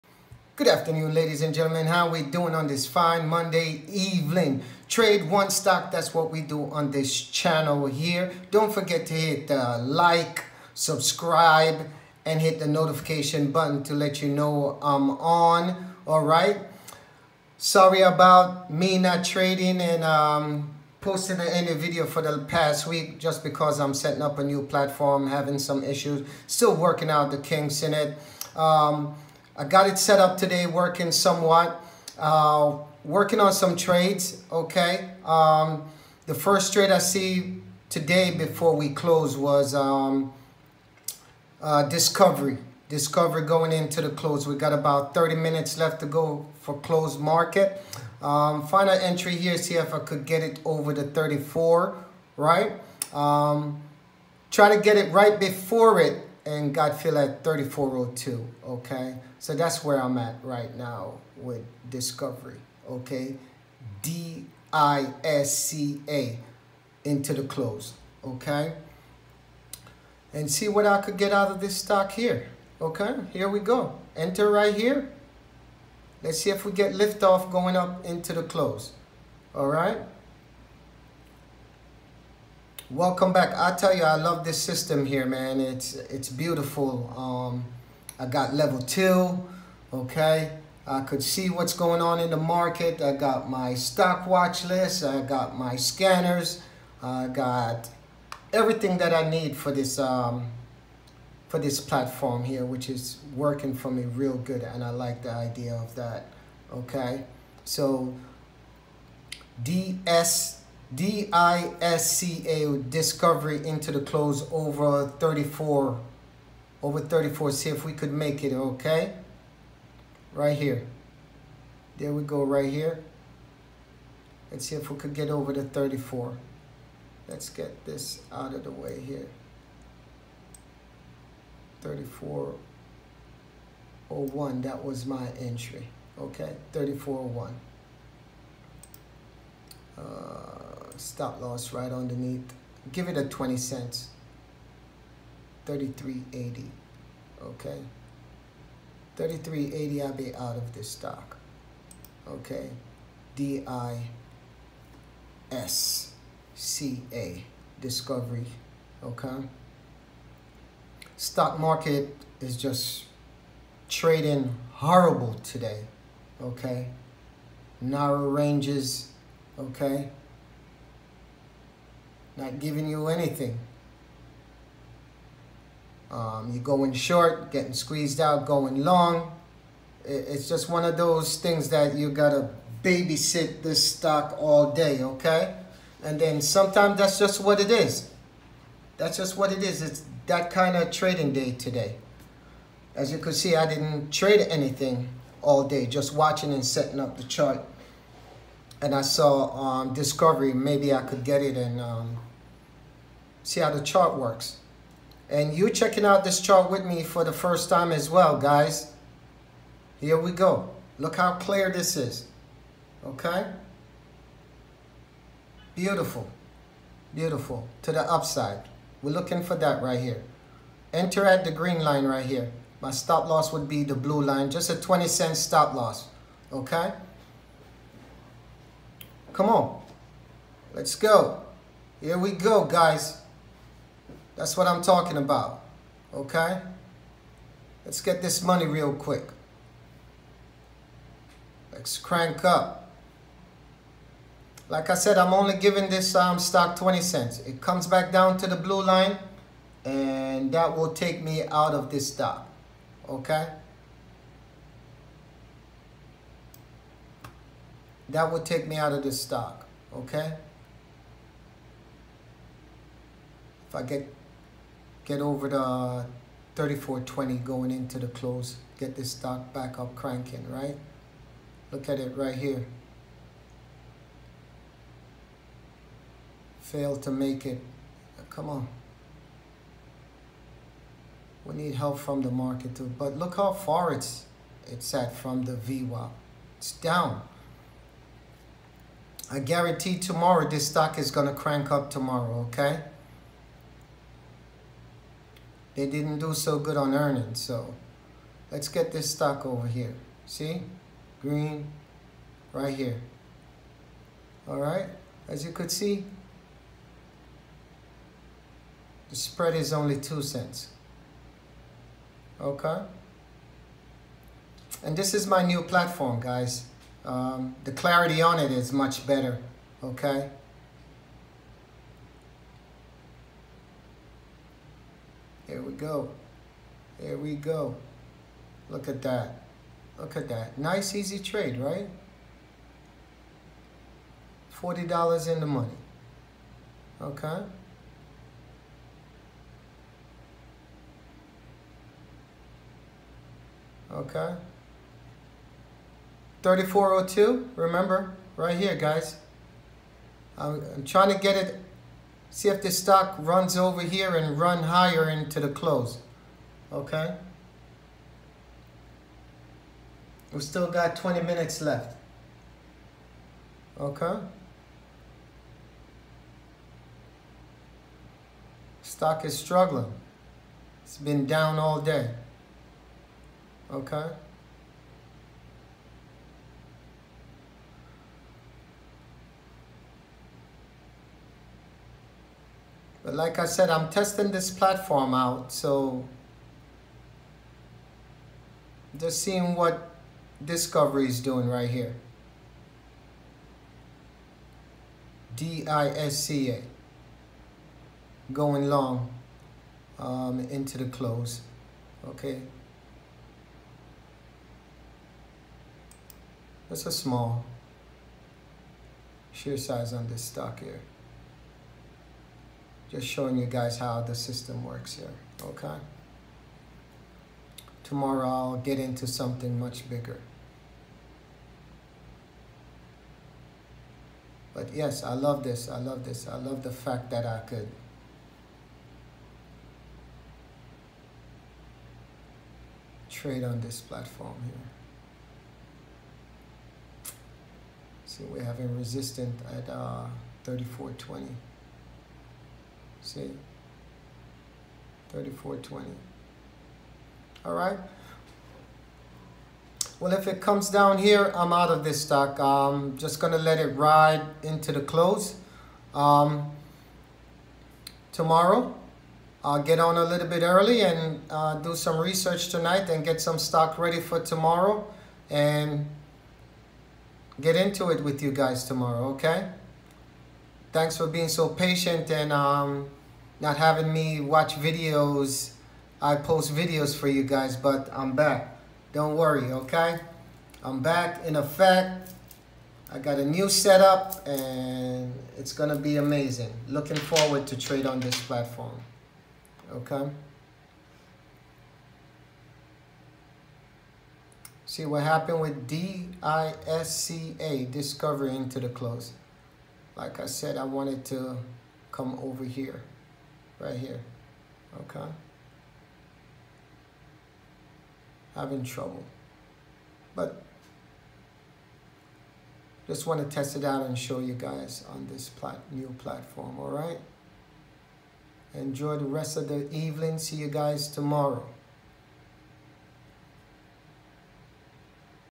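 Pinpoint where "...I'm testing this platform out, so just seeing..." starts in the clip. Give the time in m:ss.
6:23.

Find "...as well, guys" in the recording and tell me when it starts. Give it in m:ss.
3:27.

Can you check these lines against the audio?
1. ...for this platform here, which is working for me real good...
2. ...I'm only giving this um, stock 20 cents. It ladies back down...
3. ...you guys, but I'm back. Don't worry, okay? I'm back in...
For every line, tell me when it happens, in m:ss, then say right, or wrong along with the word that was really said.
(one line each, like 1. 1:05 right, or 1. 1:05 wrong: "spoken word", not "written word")
1. 1:41 right
2. 4:05 wrong: "comes", not "ladies"
3. 7:57 right.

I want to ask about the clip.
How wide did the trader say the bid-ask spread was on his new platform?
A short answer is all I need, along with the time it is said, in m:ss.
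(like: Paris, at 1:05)
2 cents, at 5:09.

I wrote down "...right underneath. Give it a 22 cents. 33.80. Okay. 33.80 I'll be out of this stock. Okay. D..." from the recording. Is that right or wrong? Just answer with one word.
wrong.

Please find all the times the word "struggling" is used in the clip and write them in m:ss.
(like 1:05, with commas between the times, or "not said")
6:09.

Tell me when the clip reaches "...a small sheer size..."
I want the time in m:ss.
6:46.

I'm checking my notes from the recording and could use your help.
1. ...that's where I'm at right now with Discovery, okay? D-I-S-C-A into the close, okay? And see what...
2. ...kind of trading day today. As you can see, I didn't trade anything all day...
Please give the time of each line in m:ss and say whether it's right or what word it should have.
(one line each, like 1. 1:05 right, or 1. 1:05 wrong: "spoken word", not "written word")
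1. 0:59 right
2. 3:10 right.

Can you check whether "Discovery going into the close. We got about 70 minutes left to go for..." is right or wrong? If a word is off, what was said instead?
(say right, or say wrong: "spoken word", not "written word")
wrong: "30", not "70".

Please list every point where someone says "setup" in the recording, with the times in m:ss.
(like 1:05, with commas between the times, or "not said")
8:03.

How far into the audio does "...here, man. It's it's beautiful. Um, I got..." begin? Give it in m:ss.
1:25.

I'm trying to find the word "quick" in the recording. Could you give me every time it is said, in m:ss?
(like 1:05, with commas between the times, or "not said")
3:58.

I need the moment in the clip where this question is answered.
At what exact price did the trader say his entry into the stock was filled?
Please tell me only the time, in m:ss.
2:11.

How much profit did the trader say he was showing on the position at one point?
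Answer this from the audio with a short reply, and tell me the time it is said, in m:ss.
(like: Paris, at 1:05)
$40, at 5:34.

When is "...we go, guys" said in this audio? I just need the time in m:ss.
3:52.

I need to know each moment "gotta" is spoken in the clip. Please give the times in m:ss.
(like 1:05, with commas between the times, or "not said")
3:02.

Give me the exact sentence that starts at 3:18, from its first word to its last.
And I saw um, Discovery, maybe I could get it and um, see how the chart works.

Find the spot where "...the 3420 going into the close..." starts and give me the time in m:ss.
4:25.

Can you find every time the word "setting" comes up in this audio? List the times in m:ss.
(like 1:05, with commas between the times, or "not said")
0:23, 3:16.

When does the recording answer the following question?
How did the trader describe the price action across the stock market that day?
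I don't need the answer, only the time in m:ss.
2:47.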